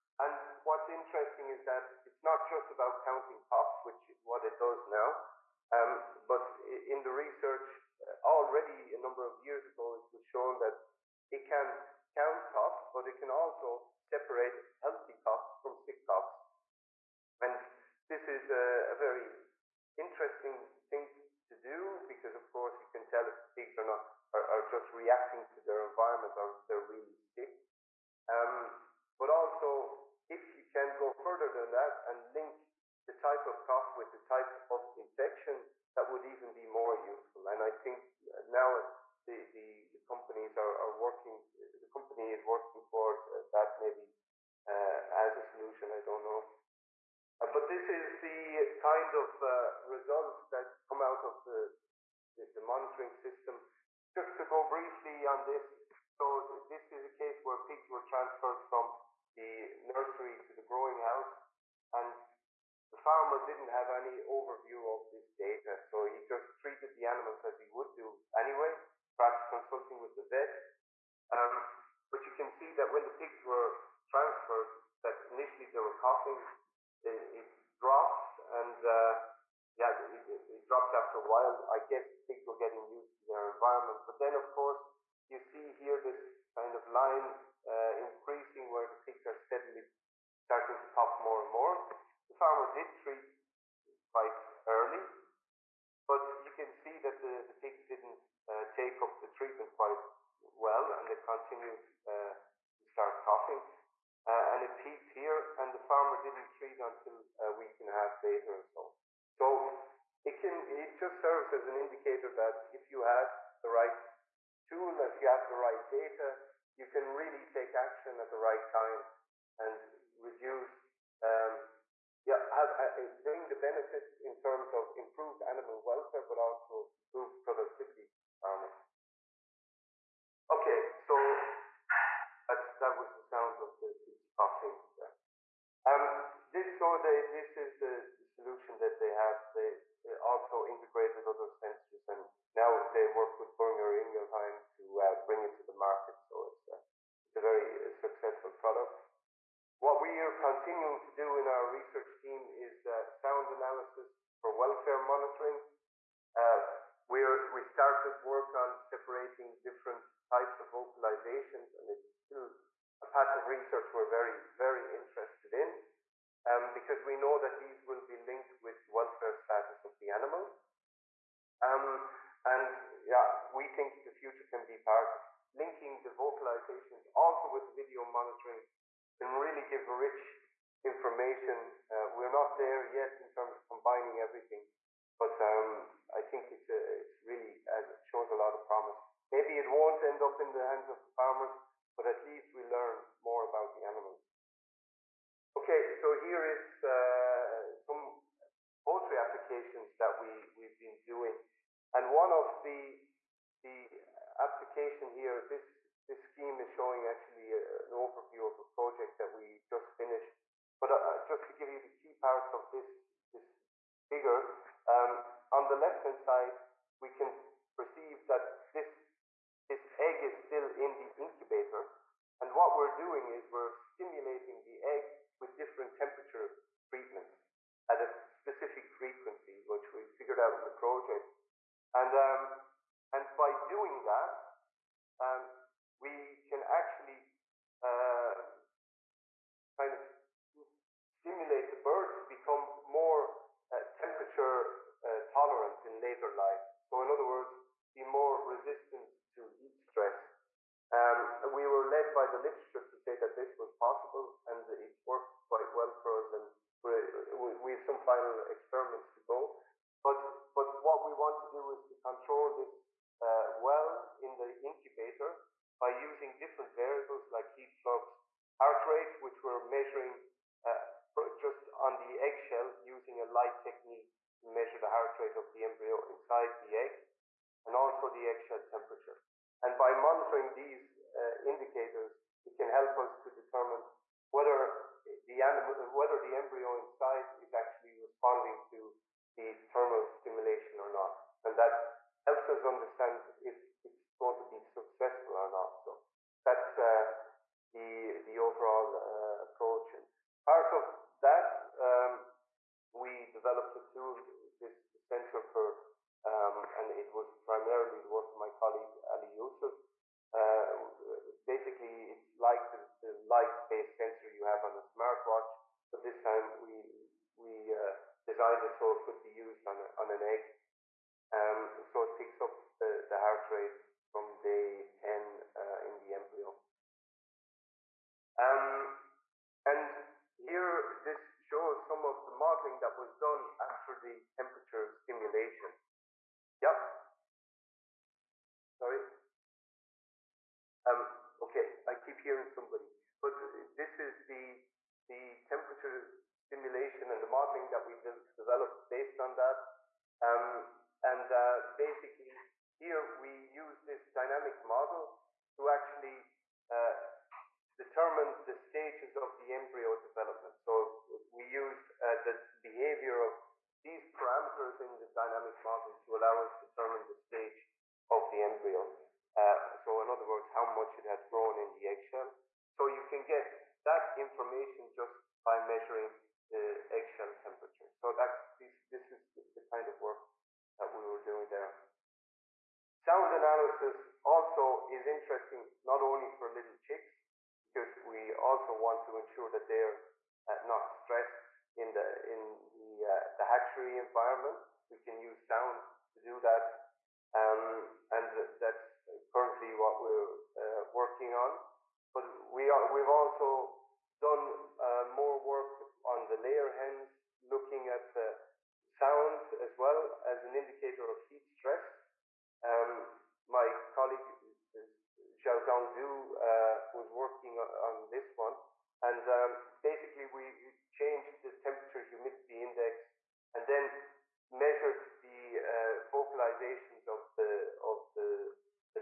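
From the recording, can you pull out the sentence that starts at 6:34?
We can use sound to do that, um, and that's currently what we're uh, working on.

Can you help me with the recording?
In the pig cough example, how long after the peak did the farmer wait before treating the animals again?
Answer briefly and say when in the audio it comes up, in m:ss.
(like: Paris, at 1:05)
a week and a half, at 1:47.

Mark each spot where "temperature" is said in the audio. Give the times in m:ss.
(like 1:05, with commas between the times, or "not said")
3:45, 4:03, 4:38, 5:34, 5:45, 6:17, 7:01.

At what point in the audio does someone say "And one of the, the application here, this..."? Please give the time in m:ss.
3:21.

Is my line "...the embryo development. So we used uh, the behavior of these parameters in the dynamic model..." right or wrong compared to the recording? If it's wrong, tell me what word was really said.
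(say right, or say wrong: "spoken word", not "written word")
right.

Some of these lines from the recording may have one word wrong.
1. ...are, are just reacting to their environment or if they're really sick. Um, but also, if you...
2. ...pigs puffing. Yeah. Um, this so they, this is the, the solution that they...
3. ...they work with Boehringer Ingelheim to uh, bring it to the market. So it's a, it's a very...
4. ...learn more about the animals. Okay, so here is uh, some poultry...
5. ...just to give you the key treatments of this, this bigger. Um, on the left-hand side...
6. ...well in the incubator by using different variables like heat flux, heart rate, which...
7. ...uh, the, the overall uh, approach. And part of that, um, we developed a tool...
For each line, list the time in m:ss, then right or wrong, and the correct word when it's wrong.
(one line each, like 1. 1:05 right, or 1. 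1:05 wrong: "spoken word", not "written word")
1. 0:24 right
2. 2:14 right
3. 2:22 right
4. 3:12 right
5. 3:31 wrong: "parts", not "treatments"
6. 4:23 right
7. 4:56 right.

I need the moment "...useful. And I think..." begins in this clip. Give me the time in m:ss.
0:37.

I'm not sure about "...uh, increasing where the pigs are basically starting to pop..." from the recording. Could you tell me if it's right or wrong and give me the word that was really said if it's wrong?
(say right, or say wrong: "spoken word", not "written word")
wrong: "steadily", not "basically".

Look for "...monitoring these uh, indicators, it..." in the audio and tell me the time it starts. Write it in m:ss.
4:39.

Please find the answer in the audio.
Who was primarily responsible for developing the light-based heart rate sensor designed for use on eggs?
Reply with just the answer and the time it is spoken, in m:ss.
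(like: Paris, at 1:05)
Ali Yusuf, at 5:09.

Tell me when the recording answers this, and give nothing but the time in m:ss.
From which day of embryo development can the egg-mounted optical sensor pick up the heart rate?
5:24.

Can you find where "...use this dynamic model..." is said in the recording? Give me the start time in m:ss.
5:53.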